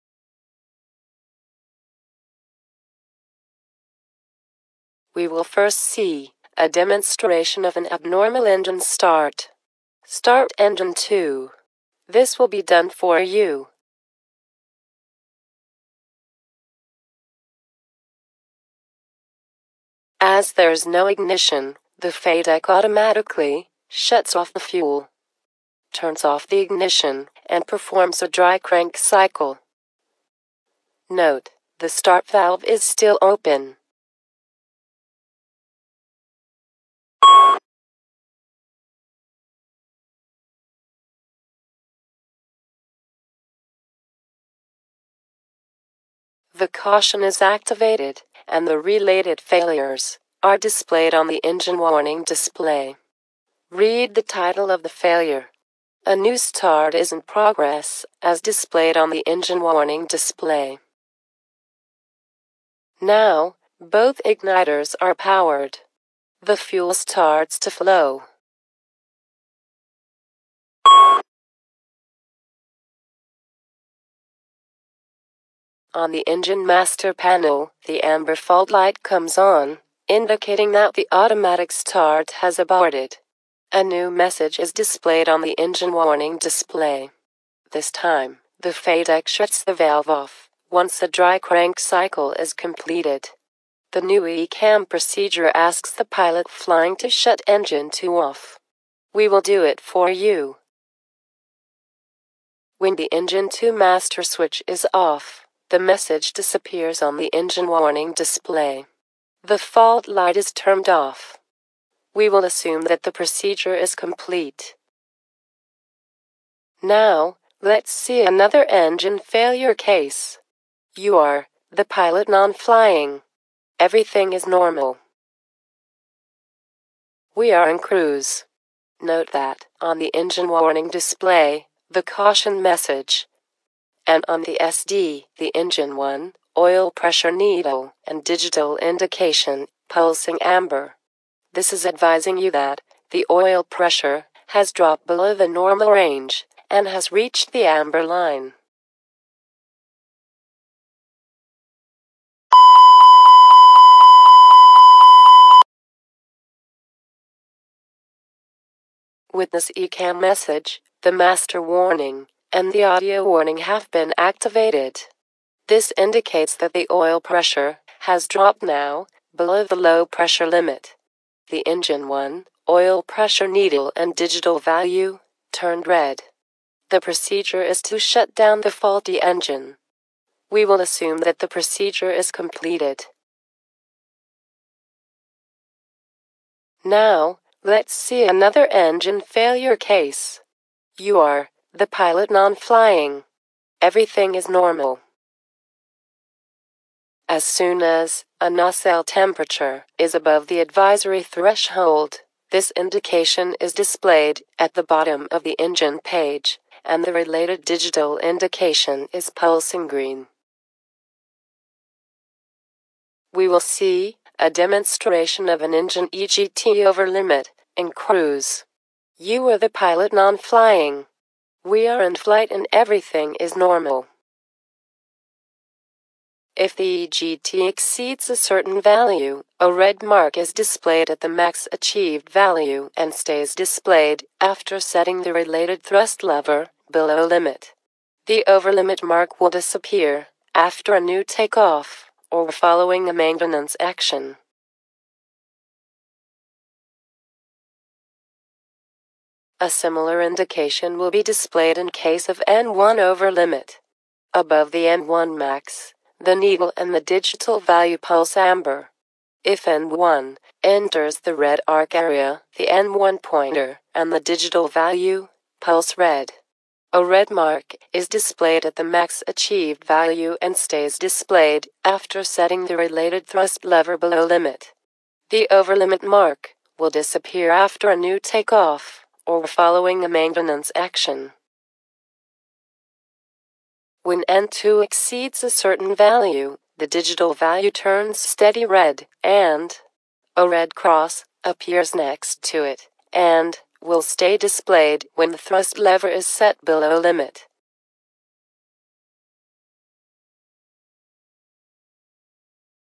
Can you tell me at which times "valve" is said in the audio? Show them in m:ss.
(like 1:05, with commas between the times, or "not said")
0:32, 1:29.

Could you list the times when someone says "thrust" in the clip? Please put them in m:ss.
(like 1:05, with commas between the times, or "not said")
3:55, 4:33, 4:55.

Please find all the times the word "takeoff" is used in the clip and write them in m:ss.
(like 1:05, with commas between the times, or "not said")
4:01, 4:38.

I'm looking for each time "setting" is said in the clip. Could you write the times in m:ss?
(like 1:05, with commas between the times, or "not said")
3:54, 4:32.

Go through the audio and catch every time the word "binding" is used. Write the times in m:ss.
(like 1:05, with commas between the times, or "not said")
not said.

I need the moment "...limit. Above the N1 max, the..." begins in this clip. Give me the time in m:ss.
4:13.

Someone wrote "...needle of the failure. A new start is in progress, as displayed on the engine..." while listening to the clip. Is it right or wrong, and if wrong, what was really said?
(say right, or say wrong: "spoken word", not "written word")
wrong: "title", not "needle".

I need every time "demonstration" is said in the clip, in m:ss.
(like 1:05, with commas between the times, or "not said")
0:06, 3:34.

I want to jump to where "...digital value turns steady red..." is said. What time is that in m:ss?
4:46.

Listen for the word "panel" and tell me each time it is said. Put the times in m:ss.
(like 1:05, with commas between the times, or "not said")
1:17.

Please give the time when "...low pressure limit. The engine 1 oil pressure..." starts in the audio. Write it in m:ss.
2:49.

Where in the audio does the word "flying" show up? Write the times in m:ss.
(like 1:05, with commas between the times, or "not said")
1:36, 2:02, 3:12, 3:40.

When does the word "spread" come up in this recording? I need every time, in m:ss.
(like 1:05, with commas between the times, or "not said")
not said.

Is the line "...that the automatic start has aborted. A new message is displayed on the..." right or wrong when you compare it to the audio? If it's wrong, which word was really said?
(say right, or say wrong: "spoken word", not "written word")
right.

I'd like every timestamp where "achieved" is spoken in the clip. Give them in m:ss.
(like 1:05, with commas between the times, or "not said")
3:51, 4:29.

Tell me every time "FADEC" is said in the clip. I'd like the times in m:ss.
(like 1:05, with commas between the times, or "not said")
0:22, 1:28.